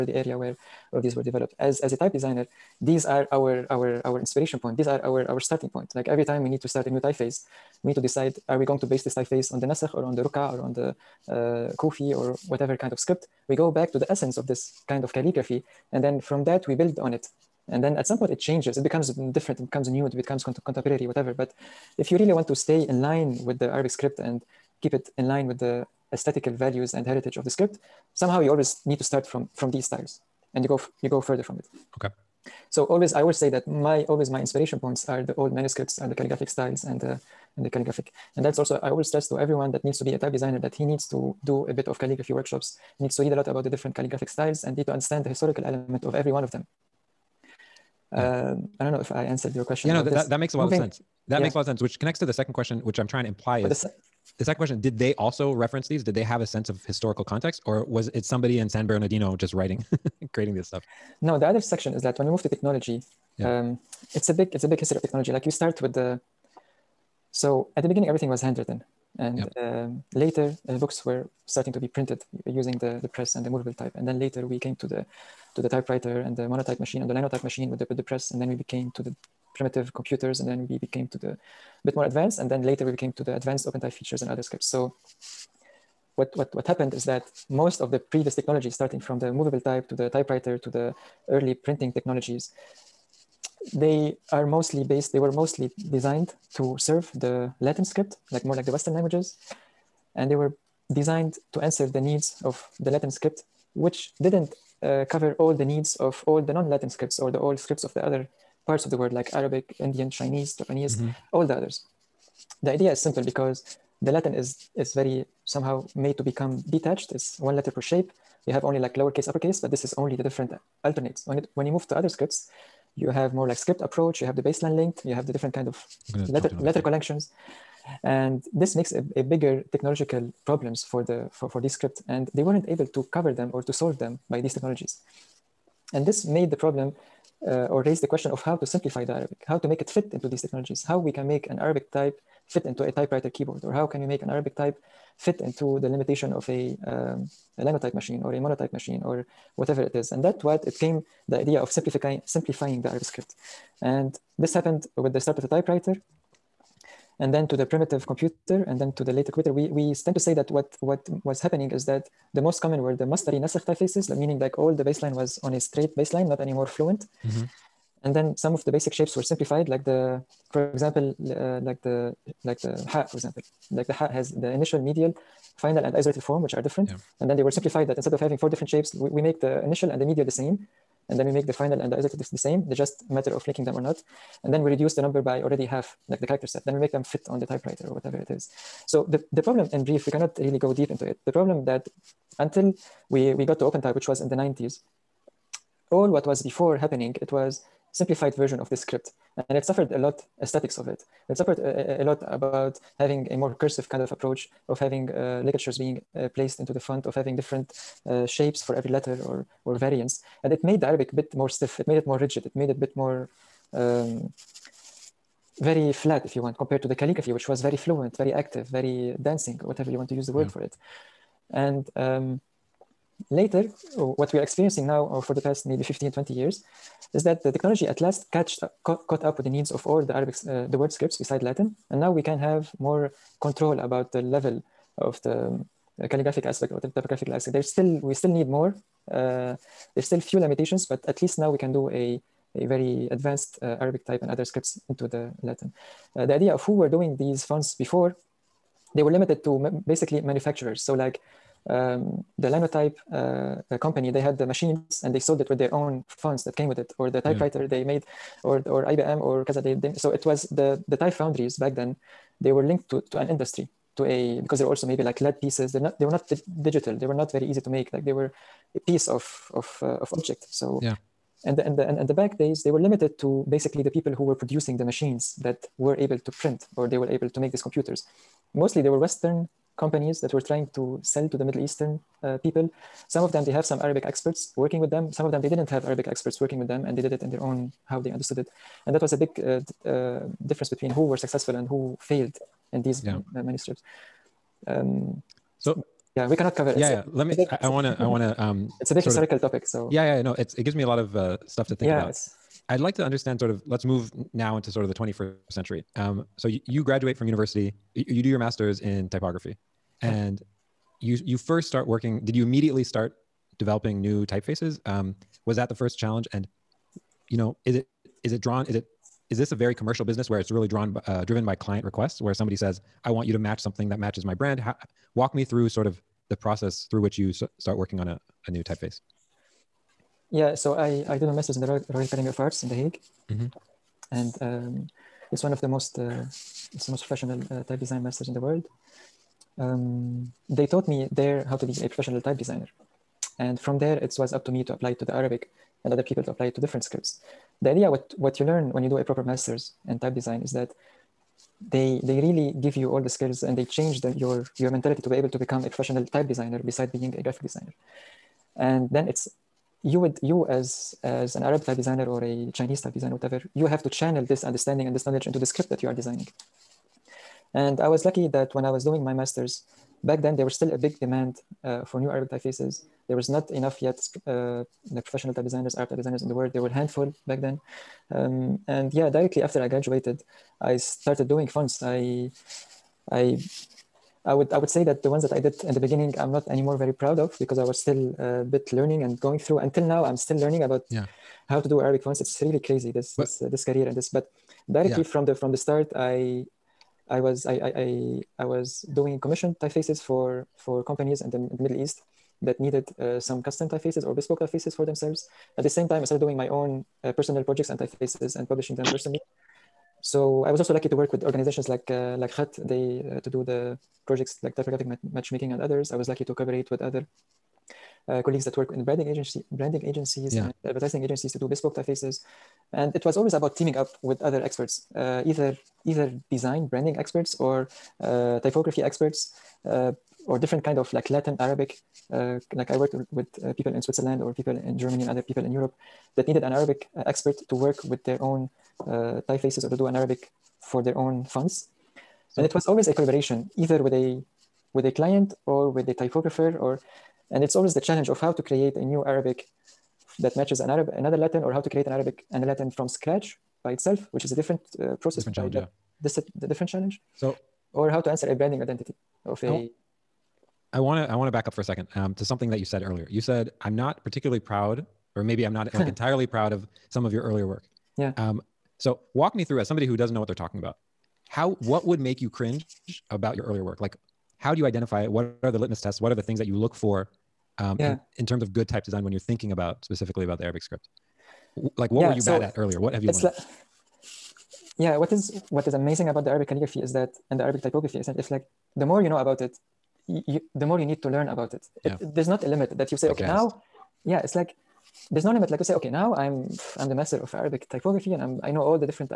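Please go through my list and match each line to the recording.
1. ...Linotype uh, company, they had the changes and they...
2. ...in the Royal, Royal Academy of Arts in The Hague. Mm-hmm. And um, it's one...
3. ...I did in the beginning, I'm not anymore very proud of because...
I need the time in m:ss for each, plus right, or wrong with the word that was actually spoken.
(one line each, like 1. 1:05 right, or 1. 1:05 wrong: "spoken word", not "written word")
1. 4:12 wrong: "machines", not "changes"
2. 5:31 right
3. 6:25 right.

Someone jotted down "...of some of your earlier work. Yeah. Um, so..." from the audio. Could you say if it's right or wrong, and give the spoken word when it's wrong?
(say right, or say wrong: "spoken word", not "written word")
right.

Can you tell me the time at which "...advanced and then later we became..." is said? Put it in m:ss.
1:22.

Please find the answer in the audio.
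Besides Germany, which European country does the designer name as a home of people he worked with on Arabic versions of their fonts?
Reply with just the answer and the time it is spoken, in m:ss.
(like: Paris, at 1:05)
Switzerland, at 7:13.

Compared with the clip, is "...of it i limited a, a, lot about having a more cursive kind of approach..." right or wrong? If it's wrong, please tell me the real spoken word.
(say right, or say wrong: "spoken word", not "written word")
wrong: "suffered", not "limited".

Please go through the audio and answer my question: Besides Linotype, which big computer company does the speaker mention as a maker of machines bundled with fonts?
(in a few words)
IBM.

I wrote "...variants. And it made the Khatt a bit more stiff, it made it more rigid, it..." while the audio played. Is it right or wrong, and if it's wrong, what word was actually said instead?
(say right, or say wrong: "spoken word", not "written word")
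wrong: "Arabic", not "Khatt".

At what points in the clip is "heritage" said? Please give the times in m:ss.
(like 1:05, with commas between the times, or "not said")
0:27.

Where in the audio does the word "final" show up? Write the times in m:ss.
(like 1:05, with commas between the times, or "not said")
2:55, 3:01.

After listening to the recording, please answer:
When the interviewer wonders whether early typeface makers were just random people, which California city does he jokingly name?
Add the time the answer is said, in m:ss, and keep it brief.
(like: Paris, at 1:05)
San Bernardino, at 0:58.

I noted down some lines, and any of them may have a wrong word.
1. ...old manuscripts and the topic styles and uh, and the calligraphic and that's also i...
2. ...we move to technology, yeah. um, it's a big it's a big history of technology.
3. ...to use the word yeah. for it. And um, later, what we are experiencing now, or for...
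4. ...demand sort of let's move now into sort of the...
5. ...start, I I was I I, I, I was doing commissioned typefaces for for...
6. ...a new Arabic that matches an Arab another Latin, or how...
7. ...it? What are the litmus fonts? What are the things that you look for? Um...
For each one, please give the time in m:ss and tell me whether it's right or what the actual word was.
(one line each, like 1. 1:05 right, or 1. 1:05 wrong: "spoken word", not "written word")
1. 0:35 wrong: "calligraphic", not "topic"
2. 1:02 right
3. 3:40 right
4. 5:03 wrong: "understand", not "demand"
5. 6:35 right
6. 7:28 right
7. 7:55 wrong: "tests", not "fonts".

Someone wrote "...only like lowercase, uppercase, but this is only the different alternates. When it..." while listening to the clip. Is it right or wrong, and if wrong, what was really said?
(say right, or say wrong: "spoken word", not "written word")
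right.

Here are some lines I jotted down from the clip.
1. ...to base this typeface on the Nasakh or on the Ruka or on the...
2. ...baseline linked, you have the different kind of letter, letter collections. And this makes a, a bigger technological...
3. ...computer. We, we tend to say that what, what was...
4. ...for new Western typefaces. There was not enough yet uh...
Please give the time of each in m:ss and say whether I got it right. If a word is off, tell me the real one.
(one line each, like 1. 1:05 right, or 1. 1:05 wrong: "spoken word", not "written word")
1. 0:08 right
2. 2:04 right
3. 2:39 right
4. 6:11 wrong: "Arabic", not "Western".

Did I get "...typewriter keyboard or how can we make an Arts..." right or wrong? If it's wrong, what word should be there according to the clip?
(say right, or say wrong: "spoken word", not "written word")
wrong: "Arabic", not "Arts".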